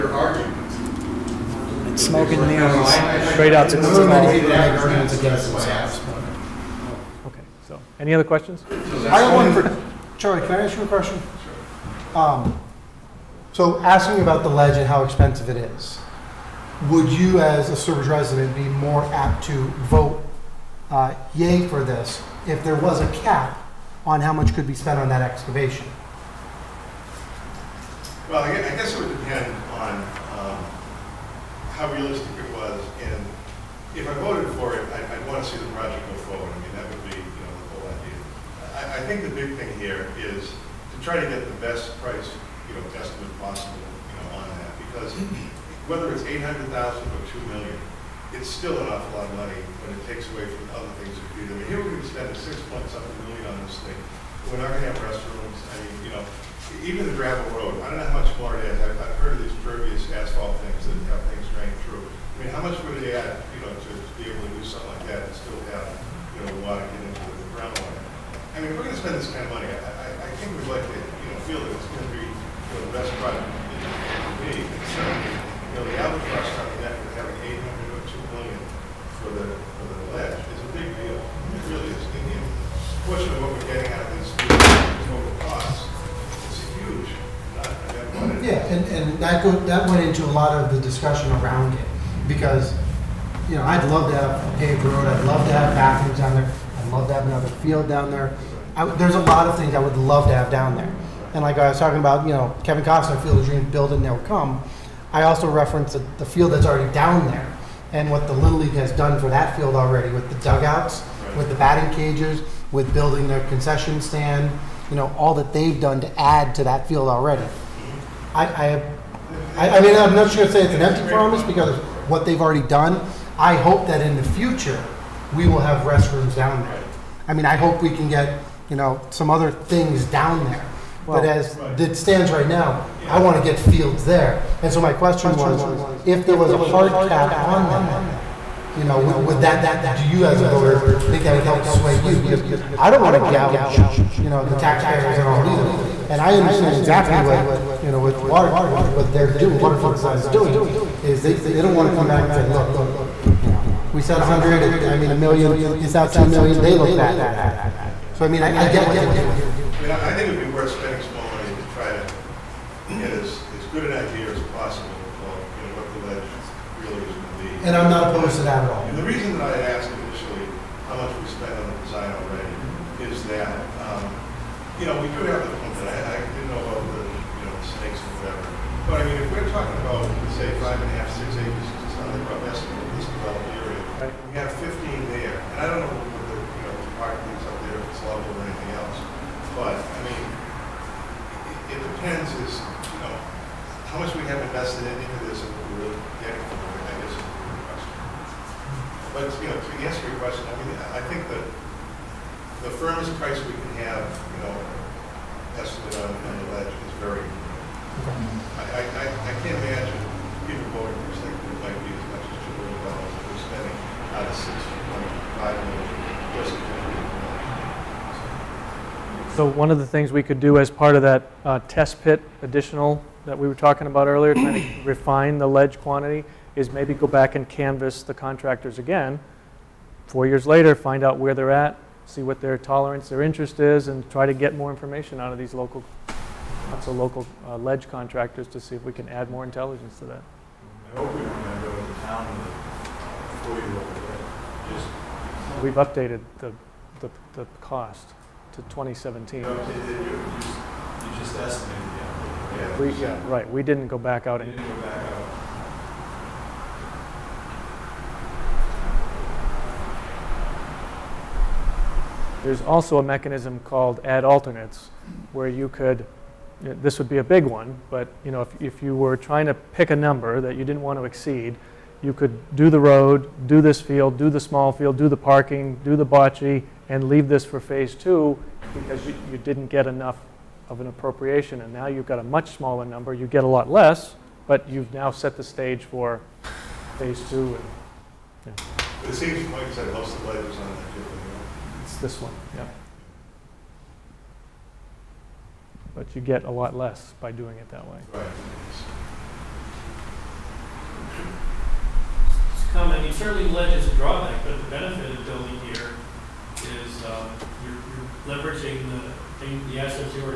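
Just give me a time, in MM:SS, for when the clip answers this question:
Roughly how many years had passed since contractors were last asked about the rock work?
03:50.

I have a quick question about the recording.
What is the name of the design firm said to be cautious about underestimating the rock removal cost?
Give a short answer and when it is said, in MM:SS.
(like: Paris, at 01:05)
Waterfield Design, at 02:29.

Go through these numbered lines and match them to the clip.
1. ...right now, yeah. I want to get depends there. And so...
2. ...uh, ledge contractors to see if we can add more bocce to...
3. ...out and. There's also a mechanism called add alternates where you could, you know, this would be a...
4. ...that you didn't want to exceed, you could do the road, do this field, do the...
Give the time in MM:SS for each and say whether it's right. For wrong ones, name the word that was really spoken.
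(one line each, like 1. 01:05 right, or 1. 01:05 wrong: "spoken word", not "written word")
1. 02:12 wrong: "fields", not "depends"
2. 03:57 wrong: "intelligence", not "bocce"
3. 04:14 right
4. 04:30 right.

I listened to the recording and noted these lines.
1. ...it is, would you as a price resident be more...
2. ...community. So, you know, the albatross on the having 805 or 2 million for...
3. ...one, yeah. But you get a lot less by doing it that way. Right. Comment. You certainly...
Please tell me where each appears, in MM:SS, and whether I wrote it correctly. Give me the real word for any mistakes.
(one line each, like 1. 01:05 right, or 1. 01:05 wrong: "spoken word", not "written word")
1. 00:15 wrong: "service", not "price"
2. 01:14 wrong: "800", not "805"
3. 04:52 right.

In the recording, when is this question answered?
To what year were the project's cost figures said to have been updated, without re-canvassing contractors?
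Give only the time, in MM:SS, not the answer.
04:08.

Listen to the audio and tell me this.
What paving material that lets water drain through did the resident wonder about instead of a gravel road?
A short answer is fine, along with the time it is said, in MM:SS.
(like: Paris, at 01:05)
pervious asphalt, at 00:59.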